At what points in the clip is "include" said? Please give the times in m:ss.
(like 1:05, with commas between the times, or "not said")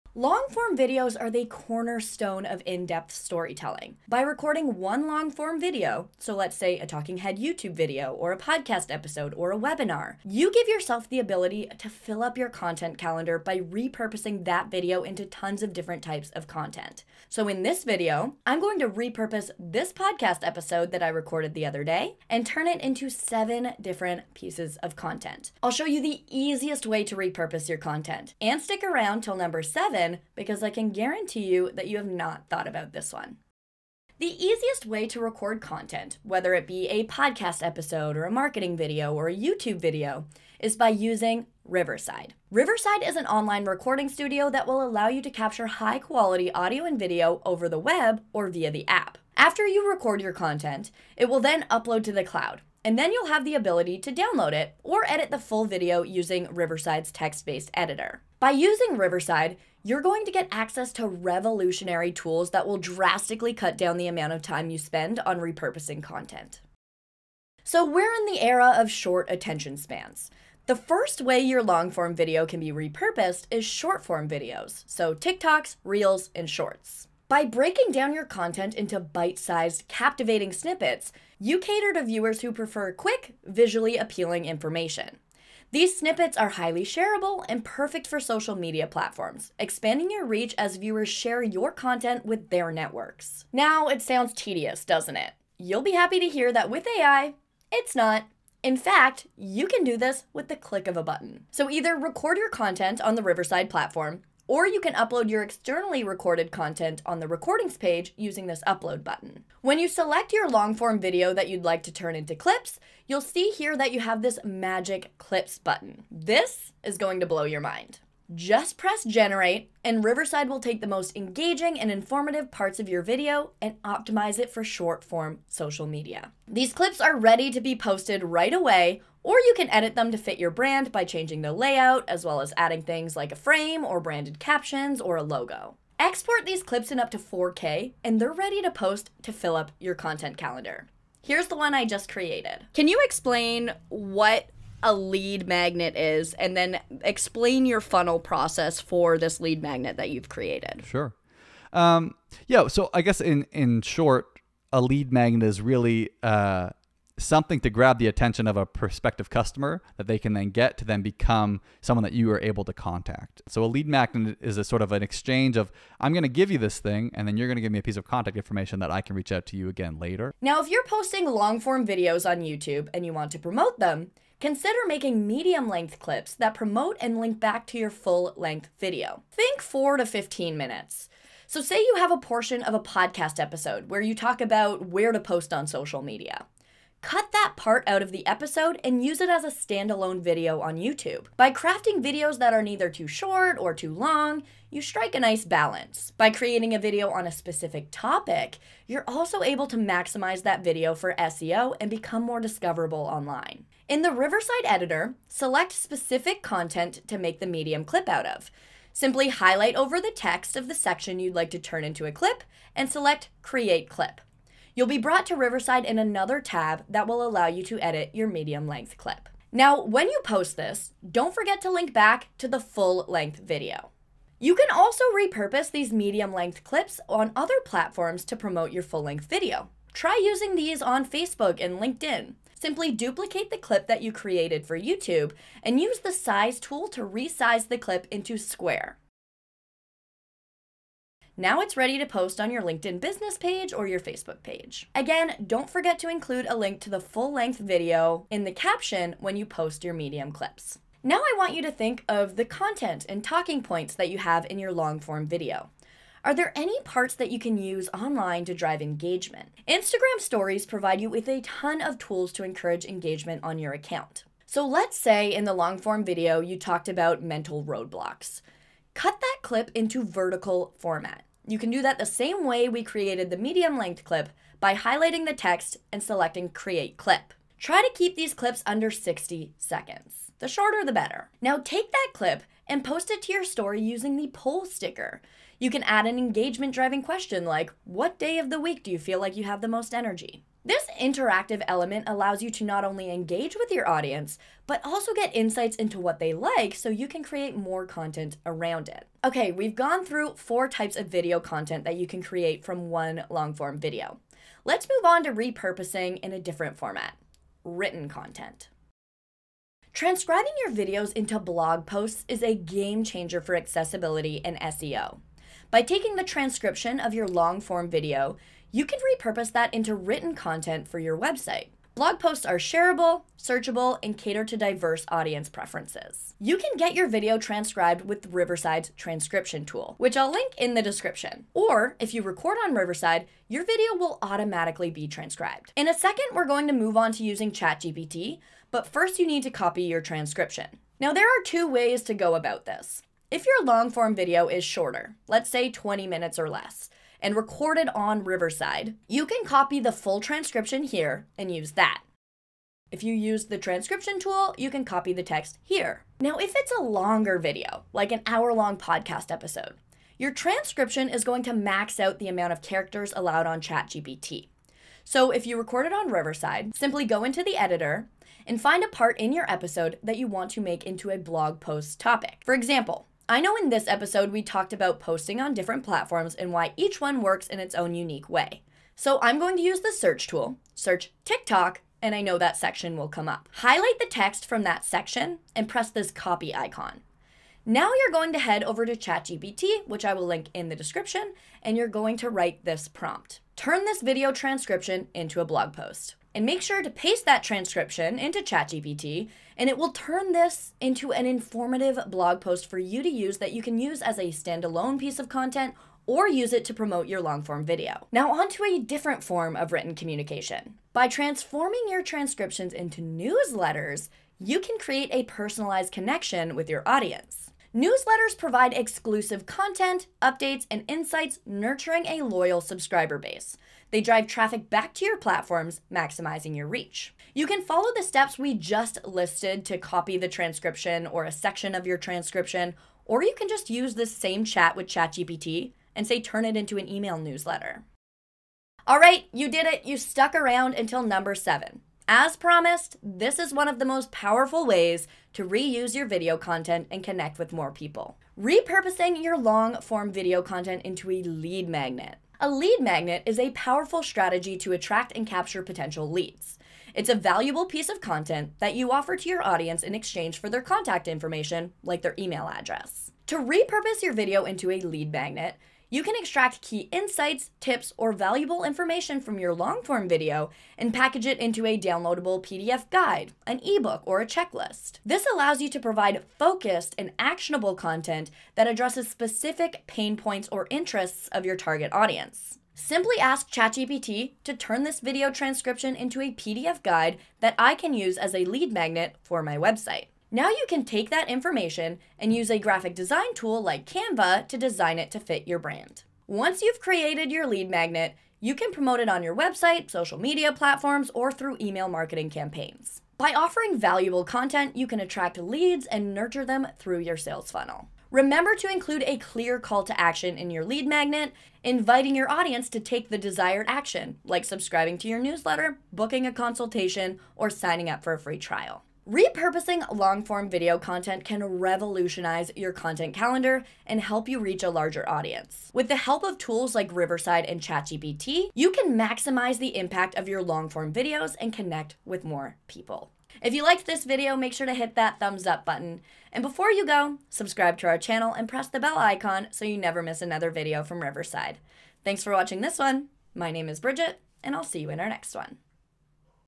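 4:06, 8:28.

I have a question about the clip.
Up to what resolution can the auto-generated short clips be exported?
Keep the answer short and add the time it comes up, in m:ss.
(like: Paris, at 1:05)
4K, at 2:17.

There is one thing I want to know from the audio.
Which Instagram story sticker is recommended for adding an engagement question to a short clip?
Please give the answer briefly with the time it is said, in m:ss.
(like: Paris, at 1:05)
poll sticker, at 4:44.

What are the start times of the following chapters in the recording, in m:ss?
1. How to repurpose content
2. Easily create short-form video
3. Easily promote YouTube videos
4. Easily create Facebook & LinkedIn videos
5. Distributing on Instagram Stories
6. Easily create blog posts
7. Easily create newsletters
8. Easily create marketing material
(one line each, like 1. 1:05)
1. 0:33
2. 1:07
3. 2:52
4. 3:45
5. 4:12
6. 5:10
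7. 6:48
8. 7:18.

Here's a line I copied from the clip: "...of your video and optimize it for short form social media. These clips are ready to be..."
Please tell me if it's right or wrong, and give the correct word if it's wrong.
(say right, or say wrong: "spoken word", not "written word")
right.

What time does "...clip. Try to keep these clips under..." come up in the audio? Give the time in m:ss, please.
4:36.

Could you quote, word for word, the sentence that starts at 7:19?
You stuck around until number seven.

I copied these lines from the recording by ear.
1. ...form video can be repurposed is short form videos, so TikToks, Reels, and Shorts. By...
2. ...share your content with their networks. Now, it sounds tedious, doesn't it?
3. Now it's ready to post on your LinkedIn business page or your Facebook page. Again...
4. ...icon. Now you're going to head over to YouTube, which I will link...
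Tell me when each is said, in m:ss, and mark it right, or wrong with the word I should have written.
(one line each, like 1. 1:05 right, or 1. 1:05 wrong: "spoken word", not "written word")
1. 1:11 right
2. 1:31 right
3. 4:01 right
4. 6:26 wrong: "ChatGPT", not "YouTube".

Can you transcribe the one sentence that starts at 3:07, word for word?
Cut that part out of the episode and use it as a standalone video on YouTube.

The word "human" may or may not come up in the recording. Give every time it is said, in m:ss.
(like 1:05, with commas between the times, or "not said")
not said.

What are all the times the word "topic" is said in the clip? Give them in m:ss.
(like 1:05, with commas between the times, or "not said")
3:17, 6:11.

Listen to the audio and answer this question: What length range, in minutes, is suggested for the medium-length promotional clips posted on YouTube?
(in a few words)
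4 to 15 minutes.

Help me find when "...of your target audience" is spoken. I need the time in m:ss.
8:01.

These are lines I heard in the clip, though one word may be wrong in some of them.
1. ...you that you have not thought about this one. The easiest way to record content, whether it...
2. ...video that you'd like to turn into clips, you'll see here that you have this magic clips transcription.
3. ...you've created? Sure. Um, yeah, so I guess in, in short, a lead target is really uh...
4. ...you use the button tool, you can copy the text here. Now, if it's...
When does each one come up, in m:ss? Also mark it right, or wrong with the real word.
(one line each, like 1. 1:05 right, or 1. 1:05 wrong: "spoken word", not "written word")
1. 0:31 right
2. 1:50 wrong: "button", not "transcription"
3. 2:30 wrong: "magnet", not "target"
4. 5:53 wrong: "transcription", not "button".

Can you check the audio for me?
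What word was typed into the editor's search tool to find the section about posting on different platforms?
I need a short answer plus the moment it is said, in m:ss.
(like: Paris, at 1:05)
TikTok, at 6:20.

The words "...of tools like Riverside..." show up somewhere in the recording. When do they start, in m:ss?
8:46.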